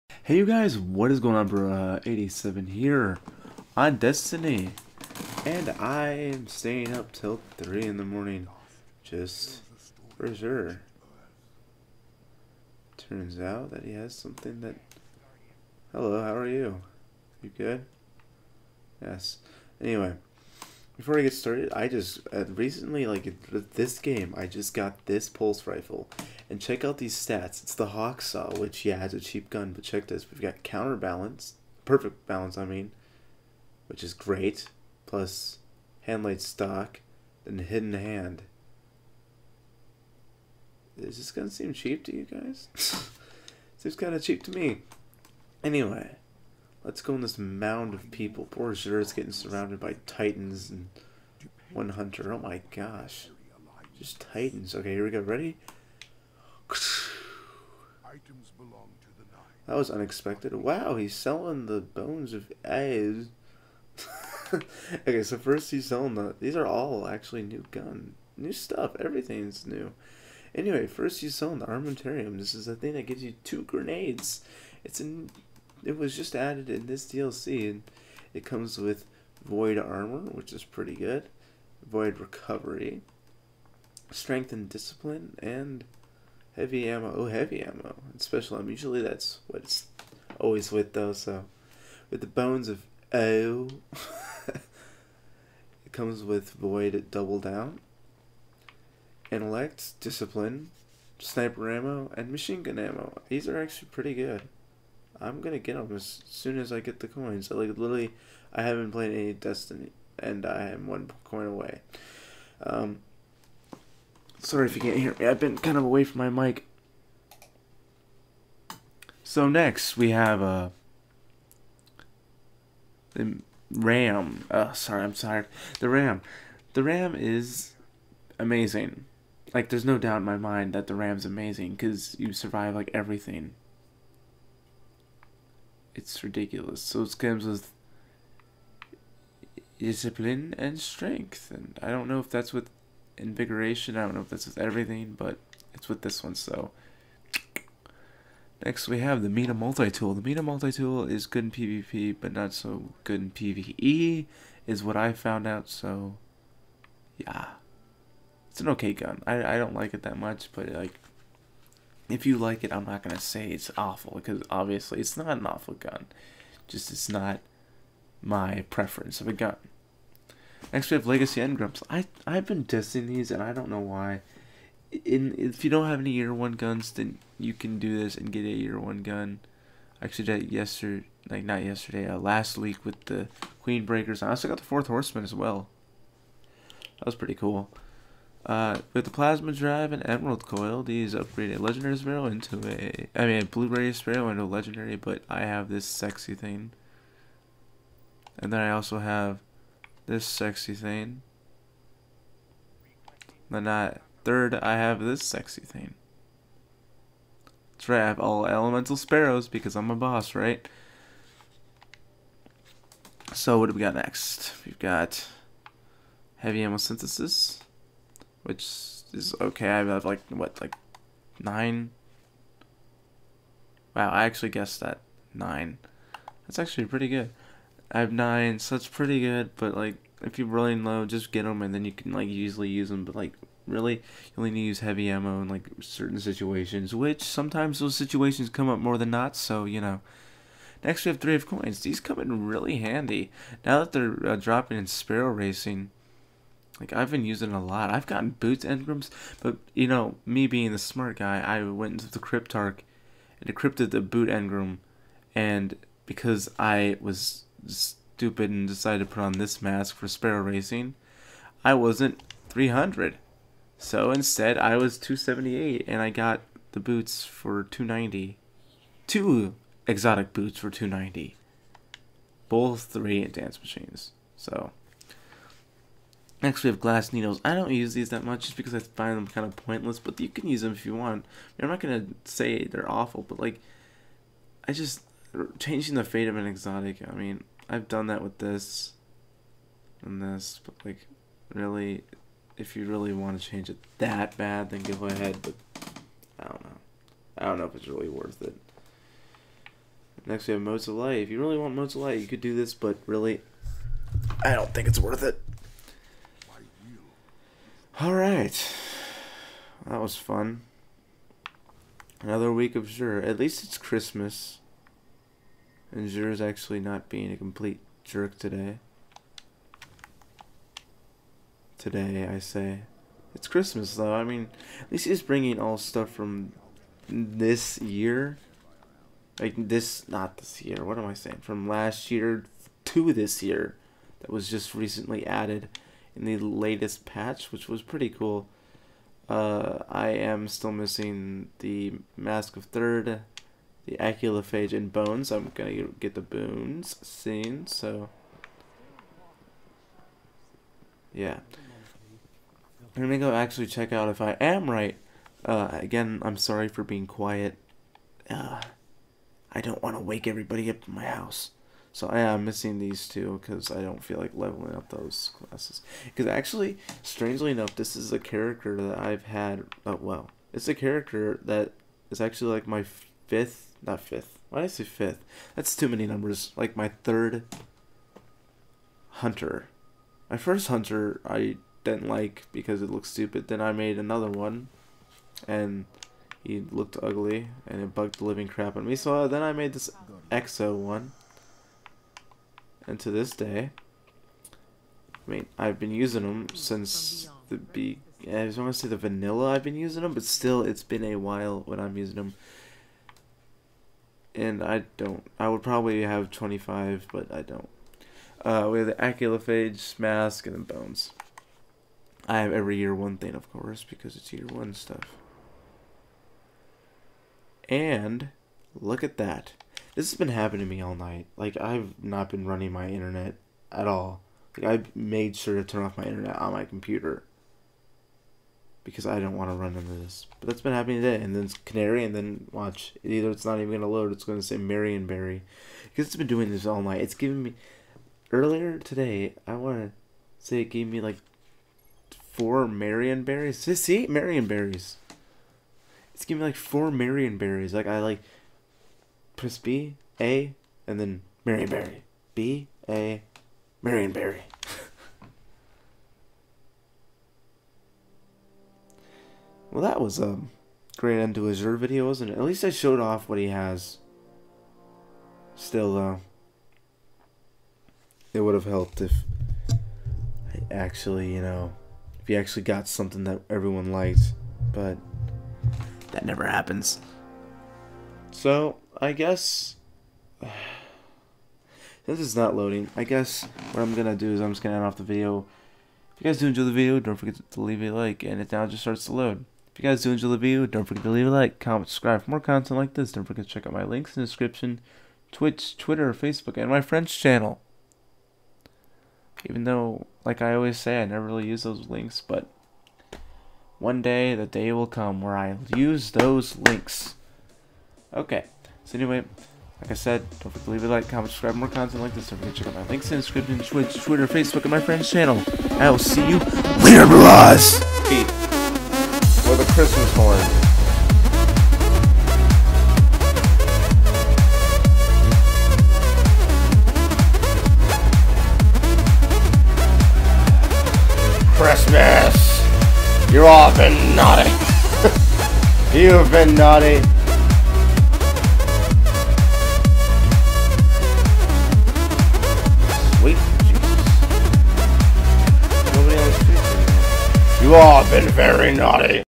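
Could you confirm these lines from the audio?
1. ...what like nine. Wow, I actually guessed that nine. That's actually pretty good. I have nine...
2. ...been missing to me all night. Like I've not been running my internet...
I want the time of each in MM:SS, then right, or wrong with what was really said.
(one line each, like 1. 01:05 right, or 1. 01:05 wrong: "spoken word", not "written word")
1. 03:40 right
2. 07:00 wrong: "happening", not "missing".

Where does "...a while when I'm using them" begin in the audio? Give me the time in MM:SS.
06:41.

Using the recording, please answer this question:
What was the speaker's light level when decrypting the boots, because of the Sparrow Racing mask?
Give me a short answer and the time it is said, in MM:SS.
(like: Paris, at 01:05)
278, at 04:24.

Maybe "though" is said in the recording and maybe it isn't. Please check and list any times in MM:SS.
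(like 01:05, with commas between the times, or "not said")
01:30, 05:23, 07:45, 08:19.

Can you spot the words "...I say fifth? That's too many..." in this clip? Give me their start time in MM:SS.
06:14.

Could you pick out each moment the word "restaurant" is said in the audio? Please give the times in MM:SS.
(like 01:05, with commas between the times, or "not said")
not said.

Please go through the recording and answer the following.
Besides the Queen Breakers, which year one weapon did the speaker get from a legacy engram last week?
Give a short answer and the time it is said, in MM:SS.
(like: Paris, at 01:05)
Fourth Horseman, at 03:04.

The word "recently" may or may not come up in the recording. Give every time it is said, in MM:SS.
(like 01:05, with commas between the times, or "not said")
00:22, 05:34.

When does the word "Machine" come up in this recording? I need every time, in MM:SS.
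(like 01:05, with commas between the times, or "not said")
01:42, 04:33.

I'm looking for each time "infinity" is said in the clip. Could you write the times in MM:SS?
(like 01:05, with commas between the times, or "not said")
not said.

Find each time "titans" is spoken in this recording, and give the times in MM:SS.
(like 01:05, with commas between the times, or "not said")
00:50, 00:54.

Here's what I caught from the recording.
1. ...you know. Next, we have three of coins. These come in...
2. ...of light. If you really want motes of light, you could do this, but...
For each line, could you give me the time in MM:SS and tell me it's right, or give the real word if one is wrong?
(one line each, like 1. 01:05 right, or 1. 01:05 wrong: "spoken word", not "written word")
1. 03:59 right
2. 05:00 right.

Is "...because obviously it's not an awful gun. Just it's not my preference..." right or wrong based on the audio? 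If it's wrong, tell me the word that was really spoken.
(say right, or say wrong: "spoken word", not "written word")
right.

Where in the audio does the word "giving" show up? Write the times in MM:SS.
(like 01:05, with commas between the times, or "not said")
07:17, 07:26.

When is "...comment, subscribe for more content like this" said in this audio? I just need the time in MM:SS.
08:11.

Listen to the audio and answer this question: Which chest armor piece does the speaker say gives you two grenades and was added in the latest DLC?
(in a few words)
Armamentarium.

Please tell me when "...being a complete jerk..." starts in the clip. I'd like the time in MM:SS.
05:17.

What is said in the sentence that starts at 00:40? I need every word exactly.
Is this gonna seem cheap to you guys?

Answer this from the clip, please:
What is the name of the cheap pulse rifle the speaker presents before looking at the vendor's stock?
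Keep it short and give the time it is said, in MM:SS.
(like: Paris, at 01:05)
Hawksaw, at 00:27.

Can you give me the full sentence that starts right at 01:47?
So, like literally, I haven't played any Destiny, and I am one coin away.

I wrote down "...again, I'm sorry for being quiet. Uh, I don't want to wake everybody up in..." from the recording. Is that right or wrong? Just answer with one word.
right.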